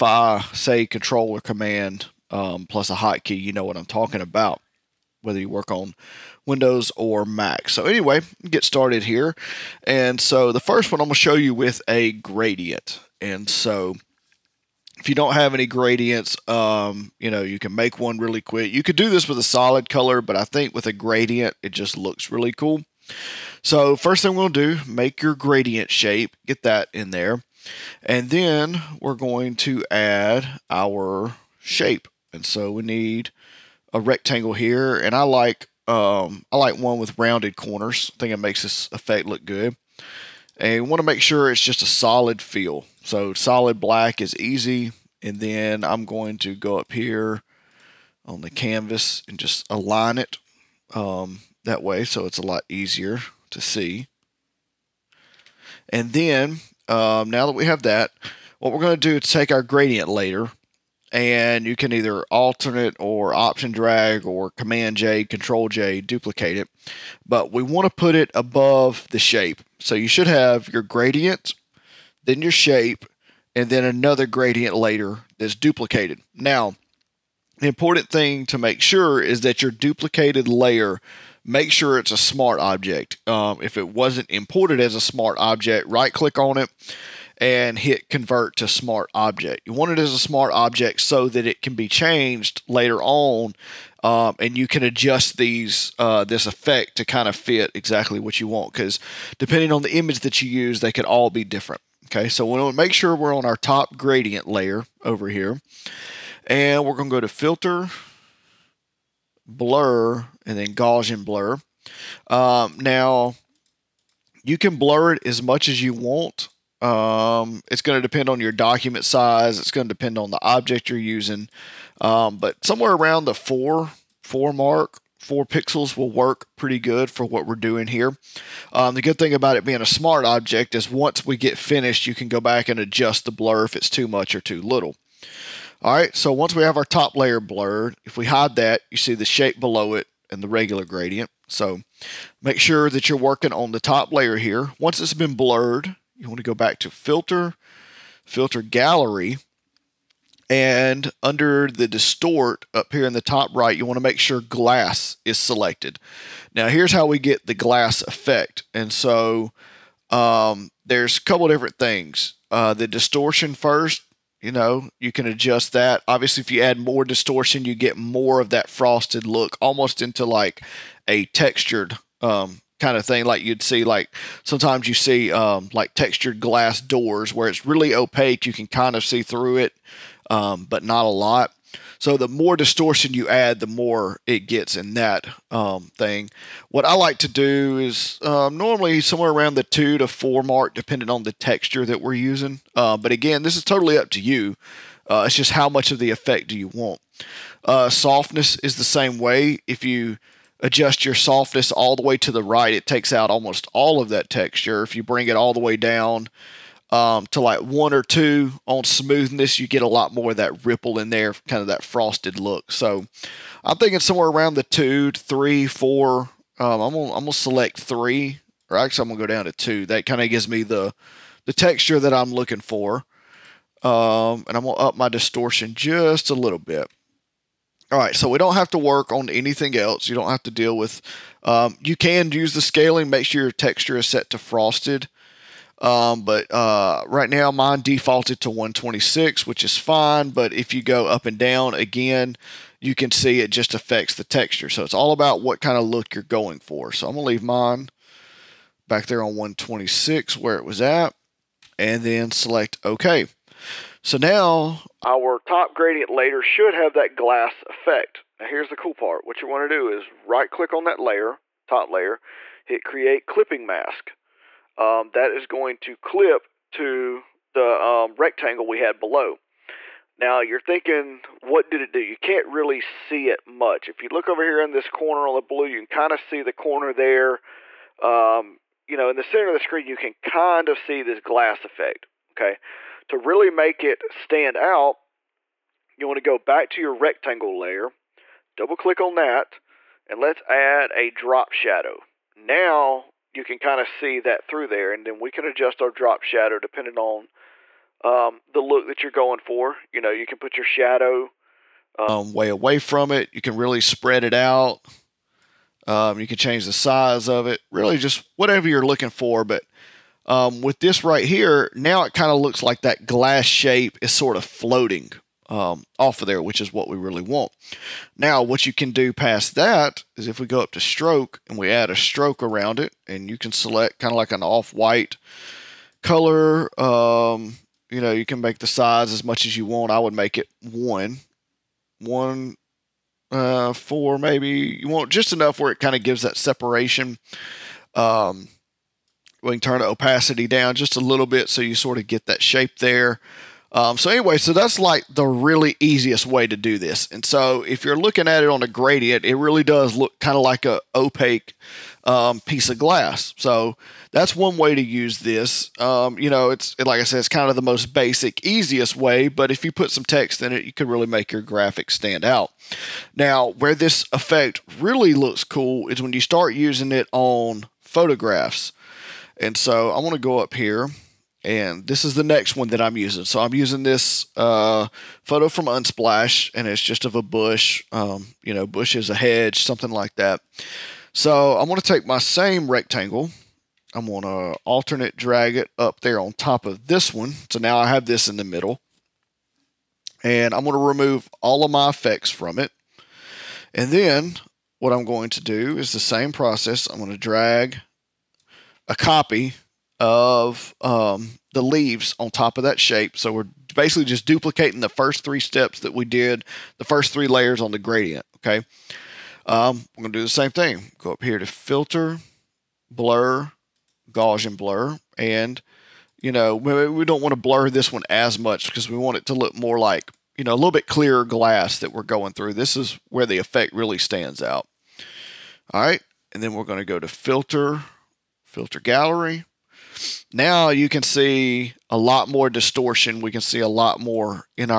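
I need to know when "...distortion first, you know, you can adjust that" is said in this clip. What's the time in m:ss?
2:42.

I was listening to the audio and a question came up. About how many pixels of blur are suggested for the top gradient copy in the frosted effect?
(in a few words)
4.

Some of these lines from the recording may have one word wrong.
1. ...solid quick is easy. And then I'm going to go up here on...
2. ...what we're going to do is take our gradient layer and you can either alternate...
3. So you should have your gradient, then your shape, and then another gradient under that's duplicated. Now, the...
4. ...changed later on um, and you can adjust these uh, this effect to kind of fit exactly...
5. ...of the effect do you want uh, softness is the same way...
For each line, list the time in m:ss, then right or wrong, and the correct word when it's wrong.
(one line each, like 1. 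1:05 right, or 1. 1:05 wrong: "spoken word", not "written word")
1. 0:43 wrong: "black", not "quick"
2. 0:58 right
3. 1:09 wrong: "layer", not "under"
4. 1:31 right
5. 3:15 right.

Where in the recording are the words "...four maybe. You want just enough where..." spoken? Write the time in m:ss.
5:33.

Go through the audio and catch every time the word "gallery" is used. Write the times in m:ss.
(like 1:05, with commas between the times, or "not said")
2:28, 7:08.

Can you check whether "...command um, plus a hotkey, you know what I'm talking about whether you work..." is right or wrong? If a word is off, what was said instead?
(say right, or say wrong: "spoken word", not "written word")
right.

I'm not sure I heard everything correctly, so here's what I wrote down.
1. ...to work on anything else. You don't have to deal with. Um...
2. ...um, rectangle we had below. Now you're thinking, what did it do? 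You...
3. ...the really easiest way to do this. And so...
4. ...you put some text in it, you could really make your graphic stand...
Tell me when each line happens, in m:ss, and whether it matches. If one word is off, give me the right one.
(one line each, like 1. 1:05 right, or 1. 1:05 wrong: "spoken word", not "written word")
1. 3:48 right
2. 4:27 right
3. 5:45 right
4. 5:59 right.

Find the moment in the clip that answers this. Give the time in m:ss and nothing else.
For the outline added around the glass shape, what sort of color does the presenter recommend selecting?
5:24.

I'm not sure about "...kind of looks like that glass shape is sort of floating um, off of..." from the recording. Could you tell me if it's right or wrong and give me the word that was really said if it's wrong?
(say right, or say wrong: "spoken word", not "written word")
right.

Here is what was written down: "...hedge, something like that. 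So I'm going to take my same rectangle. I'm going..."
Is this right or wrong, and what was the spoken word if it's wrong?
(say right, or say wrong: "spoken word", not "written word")
right.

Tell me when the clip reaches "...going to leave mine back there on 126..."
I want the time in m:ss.
4:07.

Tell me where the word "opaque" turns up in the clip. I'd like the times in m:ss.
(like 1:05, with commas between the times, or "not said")
2:57, 5:50.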